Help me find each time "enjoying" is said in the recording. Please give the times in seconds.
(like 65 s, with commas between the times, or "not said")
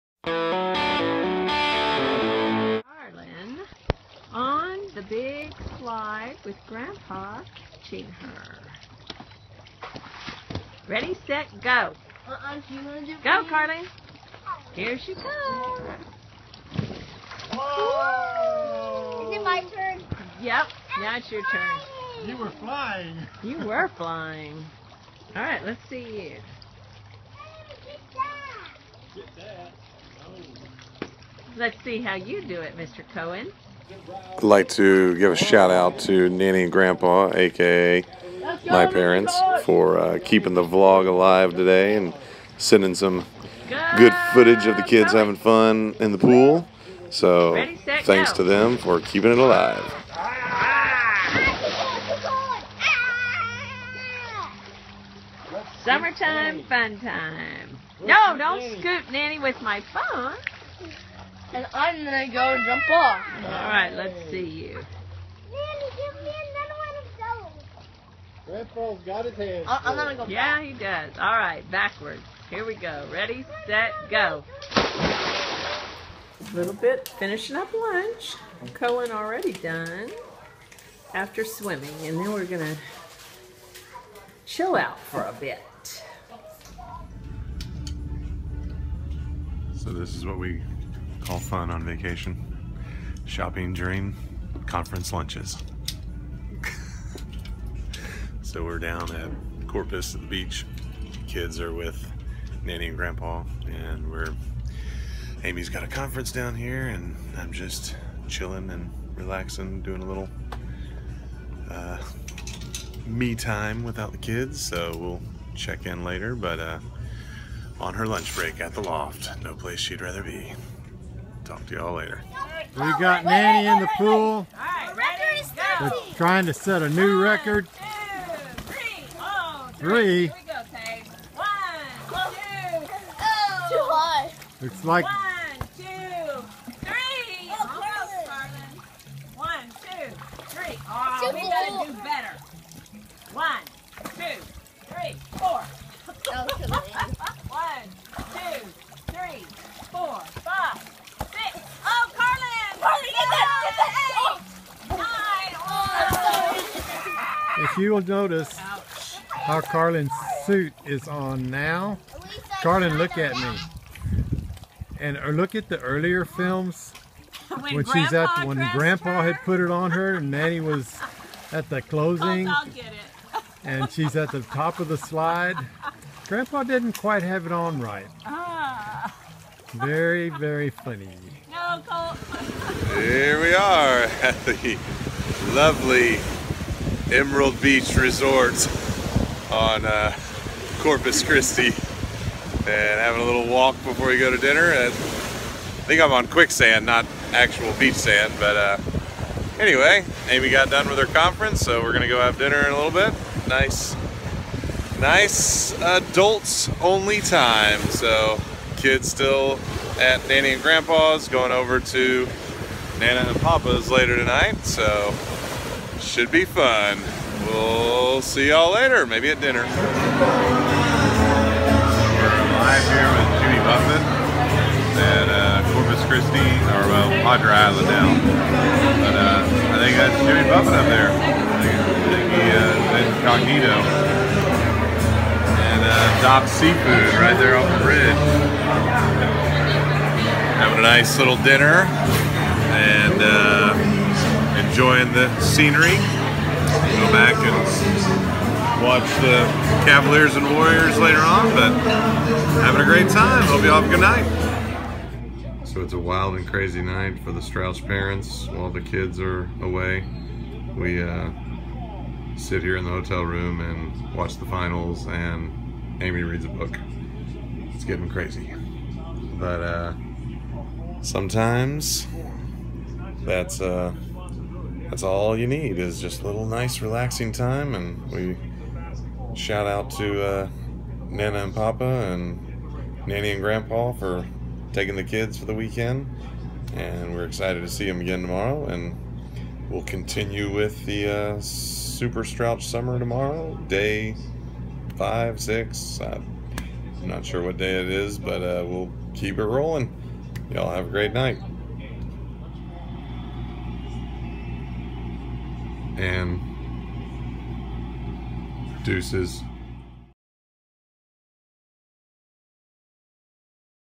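244 s.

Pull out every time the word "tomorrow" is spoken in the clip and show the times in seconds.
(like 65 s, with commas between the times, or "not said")
288 s, 292 s.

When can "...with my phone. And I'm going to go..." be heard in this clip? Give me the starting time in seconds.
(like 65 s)
59 s.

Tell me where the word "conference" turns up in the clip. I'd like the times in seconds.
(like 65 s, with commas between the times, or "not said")
94 s, 105 s, 201 s.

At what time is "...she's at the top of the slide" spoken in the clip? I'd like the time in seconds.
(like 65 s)
173 s.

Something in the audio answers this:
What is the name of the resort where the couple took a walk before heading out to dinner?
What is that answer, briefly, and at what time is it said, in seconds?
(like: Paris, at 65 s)
Emerald Beach Resort, at 187 s.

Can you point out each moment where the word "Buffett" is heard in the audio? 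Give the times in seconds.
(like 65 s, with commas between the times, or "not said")
223 s, 230 s.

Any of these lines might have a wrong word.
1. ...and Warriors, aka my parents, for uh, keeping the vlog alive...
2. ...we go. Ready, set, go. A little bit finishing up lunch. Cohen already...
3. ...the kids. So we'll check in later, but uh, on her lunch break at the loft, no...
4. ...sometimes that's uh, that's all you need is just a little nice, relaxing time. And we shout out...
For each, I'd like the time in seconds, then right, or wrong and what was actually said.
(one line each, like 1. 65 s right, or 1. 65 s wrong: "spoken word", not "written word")
1. 36 s wrong: "Grandpa", not "Warriors"
2. 72 s right
3. 114 s right
4. 271 s right.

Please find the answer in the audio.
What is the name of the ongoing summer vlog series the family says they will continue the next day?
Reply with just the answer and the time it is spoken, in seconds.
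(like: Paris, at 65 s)
Super Strauch Summer, at 291 s.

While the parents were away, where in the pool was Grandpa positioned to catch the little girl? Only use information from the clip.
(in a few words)
Big slide.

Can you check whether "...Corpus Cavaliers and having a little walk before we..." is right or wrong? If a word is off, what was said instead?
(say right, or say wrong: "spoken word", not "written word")
wrong: "Christi", not "Cavaliers".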